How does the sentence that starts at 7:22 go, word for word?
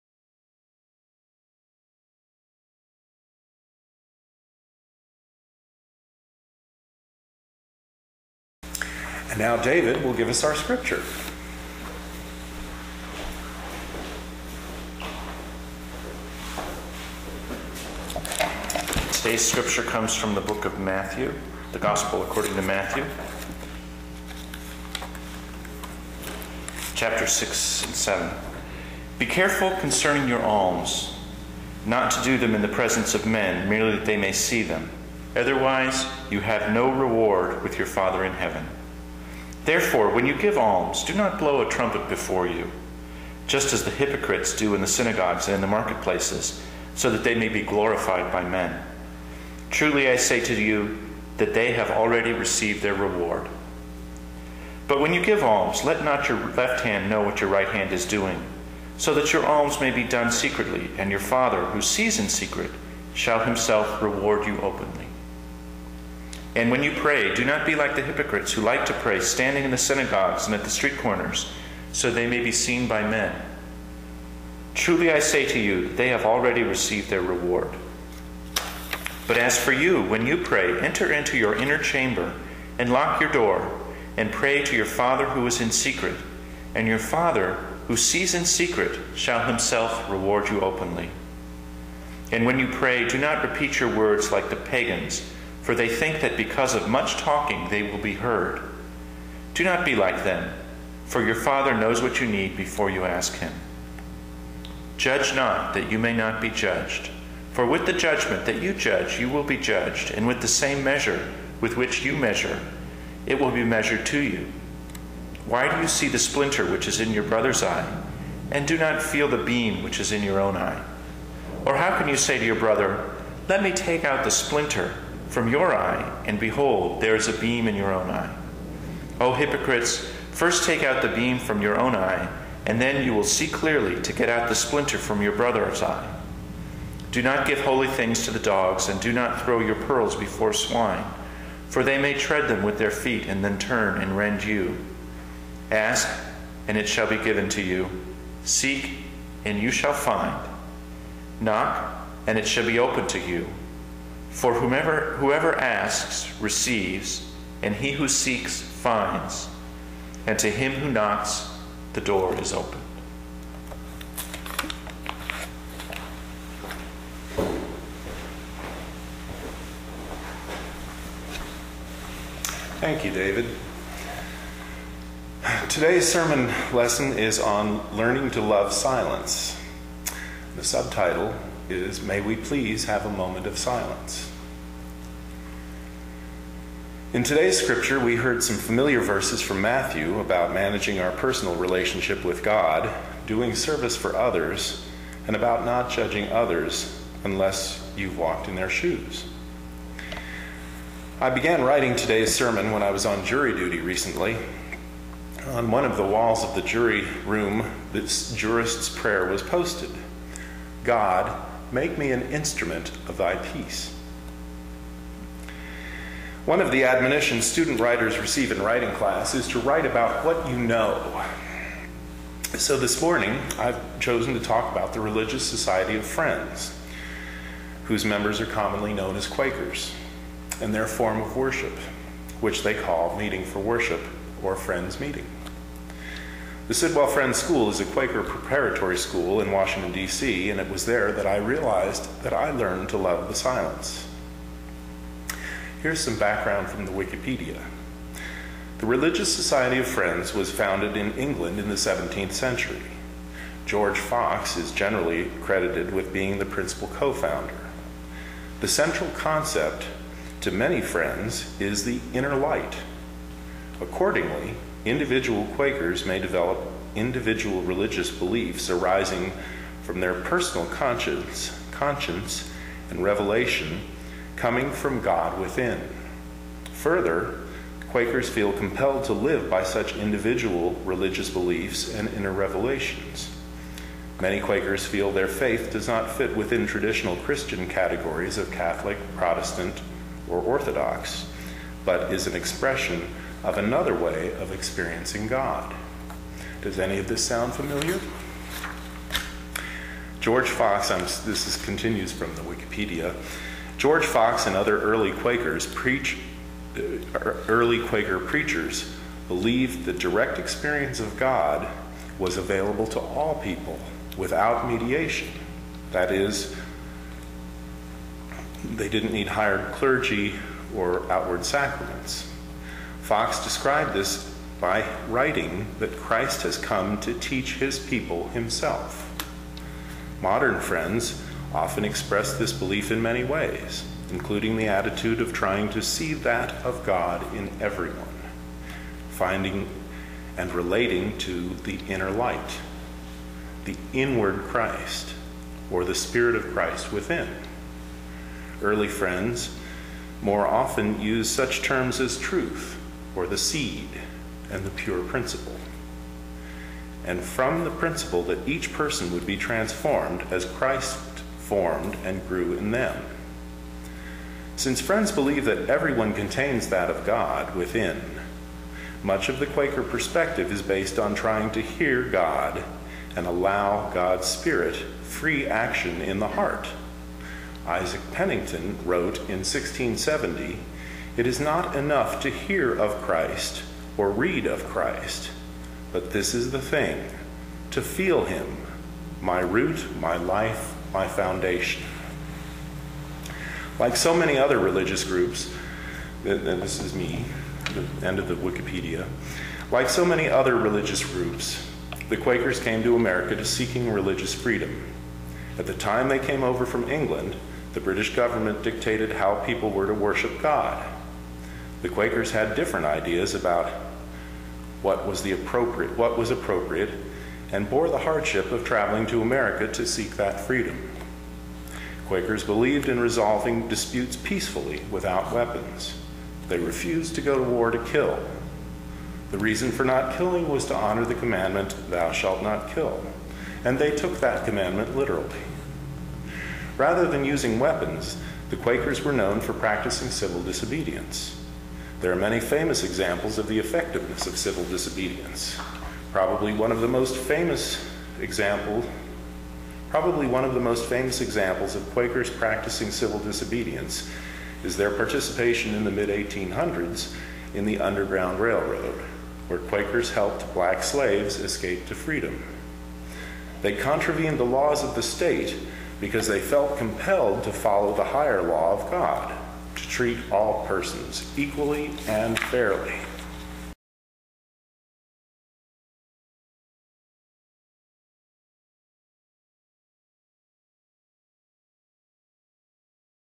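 There are many famous examples of the effectiveness of civil disobedience.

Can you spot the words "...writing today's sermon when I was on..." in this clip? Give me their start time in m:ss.
3:21.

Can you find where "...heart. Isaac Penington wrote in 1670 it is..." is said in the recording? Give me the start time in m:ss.
6:16.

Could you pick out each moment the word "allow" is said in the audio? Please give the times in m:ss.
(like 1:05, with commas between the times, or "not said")
6:13.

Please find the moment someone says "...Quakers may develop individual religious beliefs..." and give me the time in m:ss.
4:25.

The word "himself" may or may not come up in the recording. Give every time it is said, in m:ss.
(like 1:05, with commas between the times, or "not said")
1:03, 1:29, 5:28.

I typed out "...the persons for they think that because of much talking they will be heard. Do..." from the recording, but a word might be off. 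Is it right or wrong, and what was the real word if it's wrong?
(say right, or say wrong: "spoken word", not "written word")
wrong: "pagans", not "persons".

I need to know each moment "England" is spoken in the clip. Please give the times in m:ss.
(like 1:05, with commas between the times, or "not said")
4:11, 6:46.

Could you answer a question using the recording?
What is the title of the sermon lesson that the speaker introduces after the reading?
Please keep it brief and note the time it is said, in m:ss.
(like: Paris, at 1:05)
learning to love silence, at 2:57.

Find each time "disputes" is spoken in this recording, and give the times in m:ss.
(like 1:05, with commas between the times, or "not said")
7:03.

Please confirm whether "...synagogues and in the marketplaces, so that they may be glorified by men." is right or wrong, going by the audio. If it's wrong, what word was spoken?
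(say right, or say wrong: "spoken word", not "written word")
right.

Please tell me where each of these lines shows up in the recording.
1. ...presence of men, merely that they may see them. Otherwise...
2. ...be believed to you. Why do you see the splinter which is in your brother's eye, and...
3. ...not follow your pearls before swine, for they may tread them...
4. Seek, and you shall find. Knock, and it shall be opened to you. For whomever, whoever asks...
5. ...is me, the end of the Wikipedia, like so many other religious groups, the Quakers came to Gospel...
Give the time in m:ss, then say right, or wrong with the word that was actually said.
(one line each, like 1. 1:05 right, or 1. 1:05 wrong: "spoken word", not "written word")
1. 0:32 right
2. 1:53 wrong: "measured", not "believed"
3. 2:19 wrong: "throw", not "follow"
4. 2:28 right
5. 6:36 wrong: "America", not "Gospel".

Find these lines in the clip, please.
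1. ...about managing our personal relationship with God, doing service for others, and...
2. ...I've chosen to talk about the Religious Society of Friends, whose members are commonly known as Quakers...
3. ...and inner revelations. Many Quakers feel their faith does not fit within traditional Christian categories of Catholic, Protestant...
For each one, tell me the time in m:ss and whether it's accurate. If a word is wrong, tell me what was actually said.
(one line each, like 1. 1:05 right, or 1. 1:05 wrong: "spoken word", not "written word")
1. 3:10 right
2. 3:43 right
3. 4:41 right.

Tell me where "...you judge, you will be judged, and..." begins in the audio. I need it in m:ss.
1:48.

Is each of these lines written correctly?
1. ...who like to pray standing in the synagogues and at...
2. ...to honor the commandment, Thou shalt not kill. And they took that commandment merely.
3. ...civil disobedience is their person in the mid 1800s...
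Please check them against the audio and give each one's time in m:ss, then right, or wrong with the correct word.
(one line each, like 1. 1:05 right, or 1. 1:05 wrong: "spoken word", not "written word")
1. 1:08 right
2. 7:10 wrong: "literally", not "merely"
3. 7:32 wrong: "participation", not "person".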